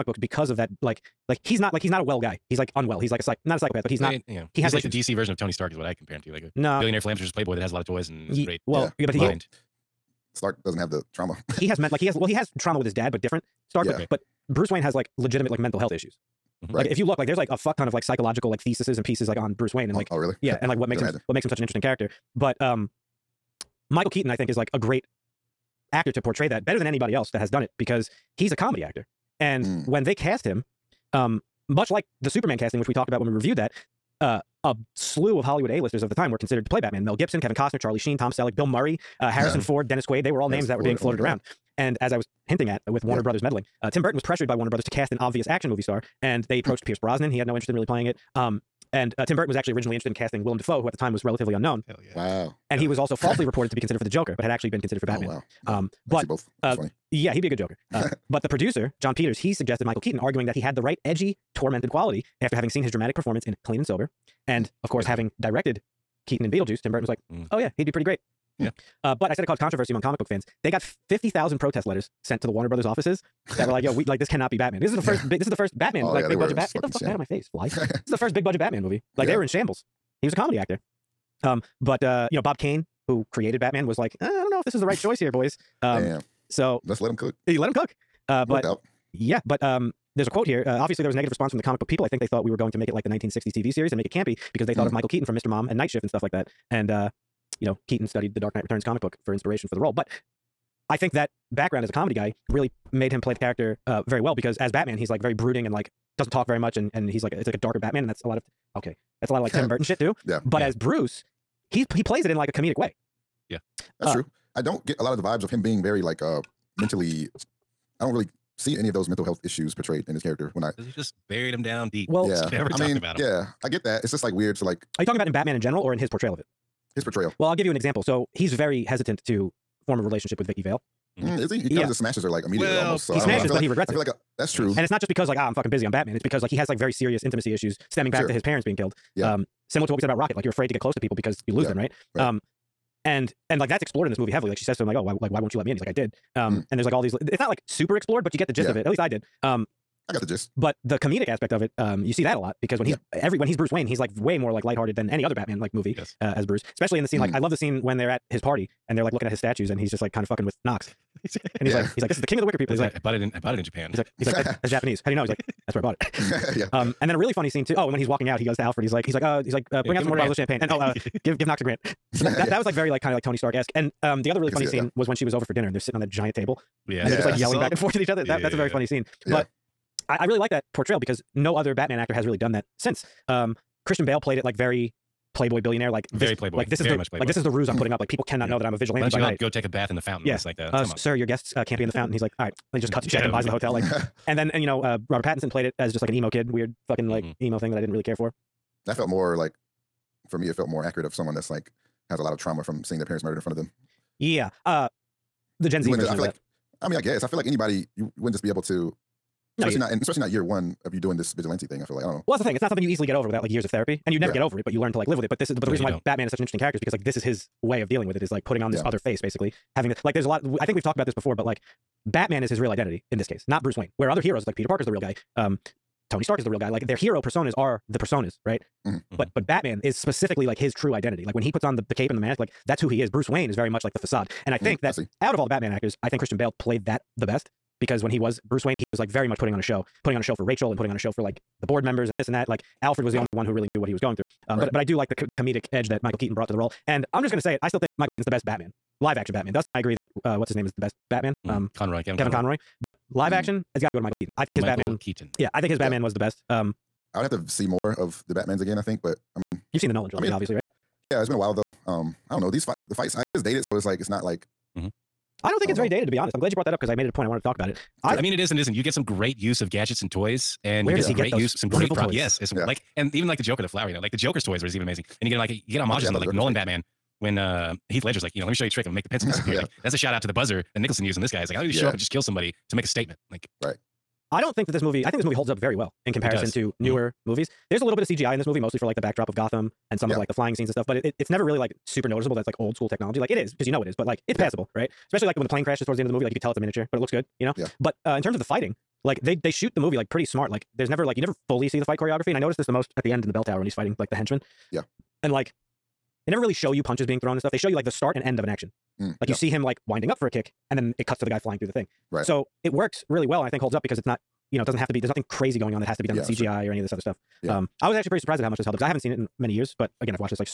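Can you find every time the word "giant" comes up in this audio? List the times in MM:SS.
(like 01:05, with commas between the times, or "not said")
02:56.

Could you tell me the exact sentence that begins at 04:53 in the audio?
Like it is, because you know it is, but like it's passable, yeah.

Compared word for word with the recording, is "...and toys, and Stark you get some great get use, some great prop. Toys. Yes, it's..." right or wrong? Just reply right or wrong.
wrong.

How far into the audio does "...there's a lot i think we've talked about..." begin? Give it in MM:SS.
03:40.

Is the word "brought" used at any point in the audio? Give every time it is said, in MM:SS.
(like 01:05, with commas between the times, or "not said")
04:06, 04:26.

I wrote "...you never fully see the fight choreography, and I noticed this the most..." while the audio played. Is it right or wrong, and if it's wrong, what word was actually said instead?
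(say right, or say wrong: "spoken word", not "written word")
right.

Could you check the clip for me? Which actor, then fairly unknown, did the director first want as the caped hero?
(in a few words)
Willem Dafoe.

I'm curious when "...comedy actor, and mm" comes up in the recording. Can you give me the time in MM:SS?
00:28.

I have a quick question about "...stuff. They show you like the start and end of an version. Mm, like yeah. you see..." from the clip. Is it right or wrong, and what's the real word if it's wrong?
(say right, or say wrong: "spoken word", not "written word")
wrong: "action", not "version".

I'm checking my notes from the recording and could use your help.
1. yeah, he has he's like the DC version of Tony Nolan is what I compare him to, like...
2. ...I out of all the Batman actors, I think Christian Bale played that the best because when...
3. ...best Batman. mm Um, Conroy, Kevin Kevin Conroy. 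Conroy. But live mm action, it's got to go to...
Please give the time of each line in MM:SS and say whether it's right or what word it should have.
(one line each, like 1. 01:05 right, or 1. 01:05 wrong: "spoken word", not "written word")
1. 00:04 wrong: "Stark", not "Nolan"
2. 03:54 right
3. 04:10 right.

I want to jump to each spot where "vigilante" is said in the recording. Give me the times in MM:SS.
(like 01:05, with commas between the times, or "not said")
03:08, 03:31.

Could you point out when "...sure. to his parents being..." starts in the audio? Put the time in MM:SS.
02:18.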